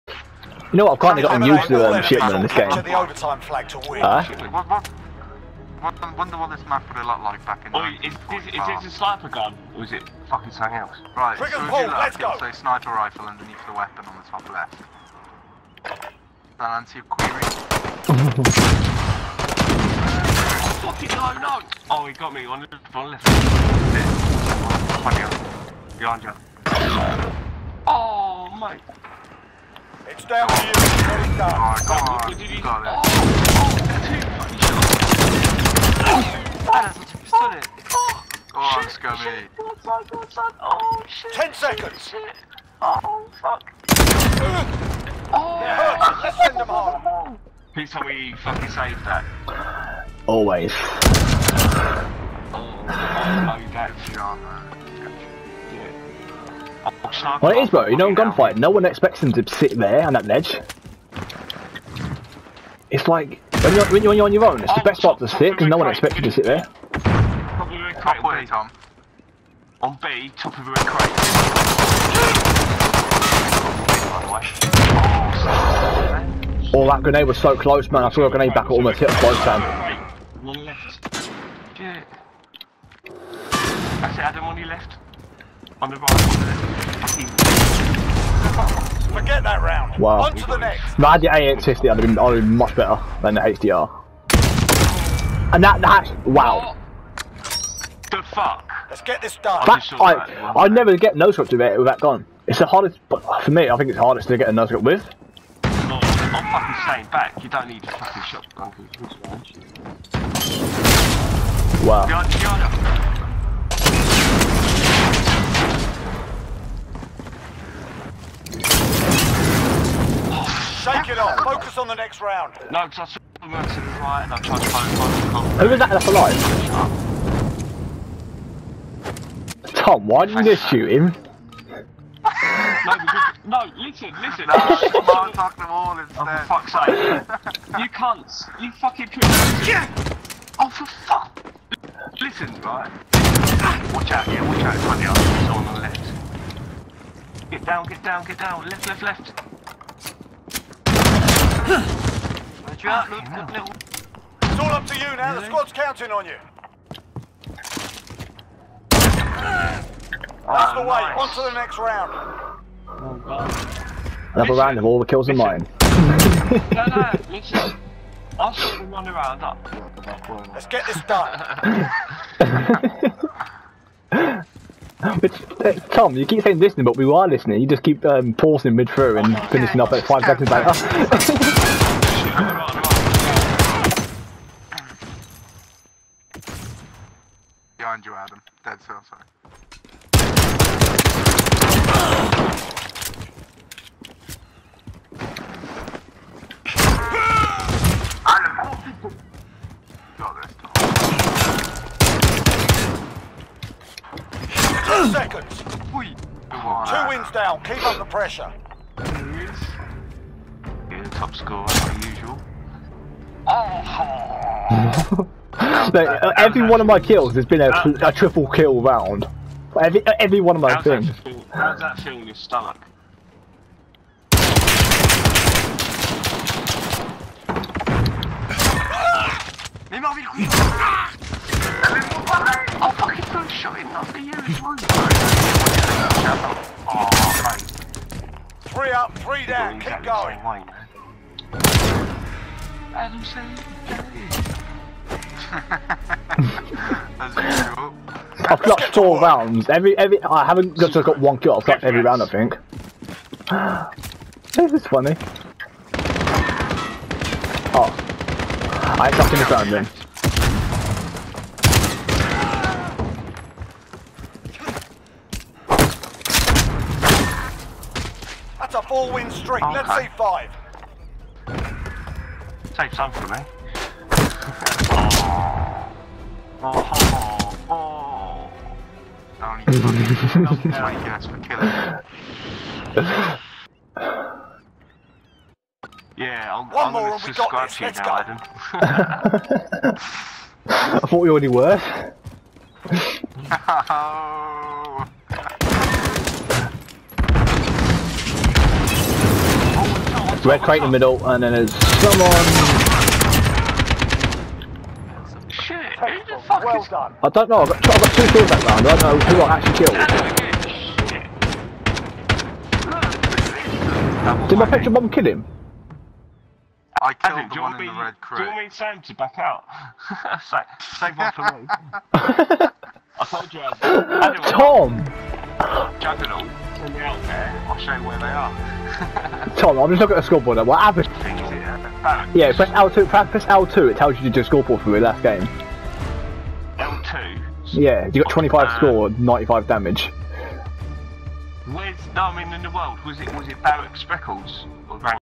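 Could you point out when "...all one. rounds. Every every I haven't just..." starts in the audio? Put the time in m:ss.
4:08.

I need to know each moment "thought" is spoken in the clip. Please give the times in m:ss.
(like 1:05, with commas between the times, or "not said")
4:51.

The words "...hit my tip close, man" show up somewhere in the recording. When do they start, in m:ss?
1:18.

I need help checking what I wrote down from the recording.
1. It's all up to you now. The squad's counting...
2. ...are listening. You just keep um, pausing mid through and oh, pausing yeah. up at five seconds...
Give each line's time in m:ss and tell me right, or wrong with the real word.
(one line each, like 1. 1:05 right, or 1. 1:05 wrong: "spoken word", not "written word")
1. 2:34 right
2. 2:57 wrong: "finishing", not "pausing".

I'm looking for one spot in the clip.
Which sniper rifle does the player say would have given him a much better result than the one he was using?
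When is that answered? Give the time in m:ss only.
1:31.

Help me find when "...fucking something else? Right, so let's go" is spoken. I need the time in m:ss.
0:10.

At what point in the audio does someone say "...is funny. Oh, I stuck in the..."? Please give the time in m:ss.
4:14.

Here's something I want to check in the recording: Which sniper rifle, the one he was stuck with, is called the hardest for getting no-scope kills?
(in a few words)
HDR.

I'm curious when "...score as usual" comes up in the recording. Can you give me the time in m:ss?
3:31.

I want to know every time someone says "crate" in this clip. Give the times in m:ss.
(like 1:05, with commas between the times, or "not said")
1:10, 5:00.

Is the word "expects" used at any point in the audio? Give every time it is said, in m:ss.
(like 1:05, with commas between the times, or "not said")
0:58, 1:05.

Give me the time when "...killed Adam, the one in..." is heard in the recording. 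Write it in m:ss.
5:17.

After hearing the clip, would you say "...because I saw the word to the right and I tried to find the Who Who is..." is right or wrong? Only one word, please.
right.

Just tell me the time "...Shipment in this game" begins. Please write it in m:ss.
0:02.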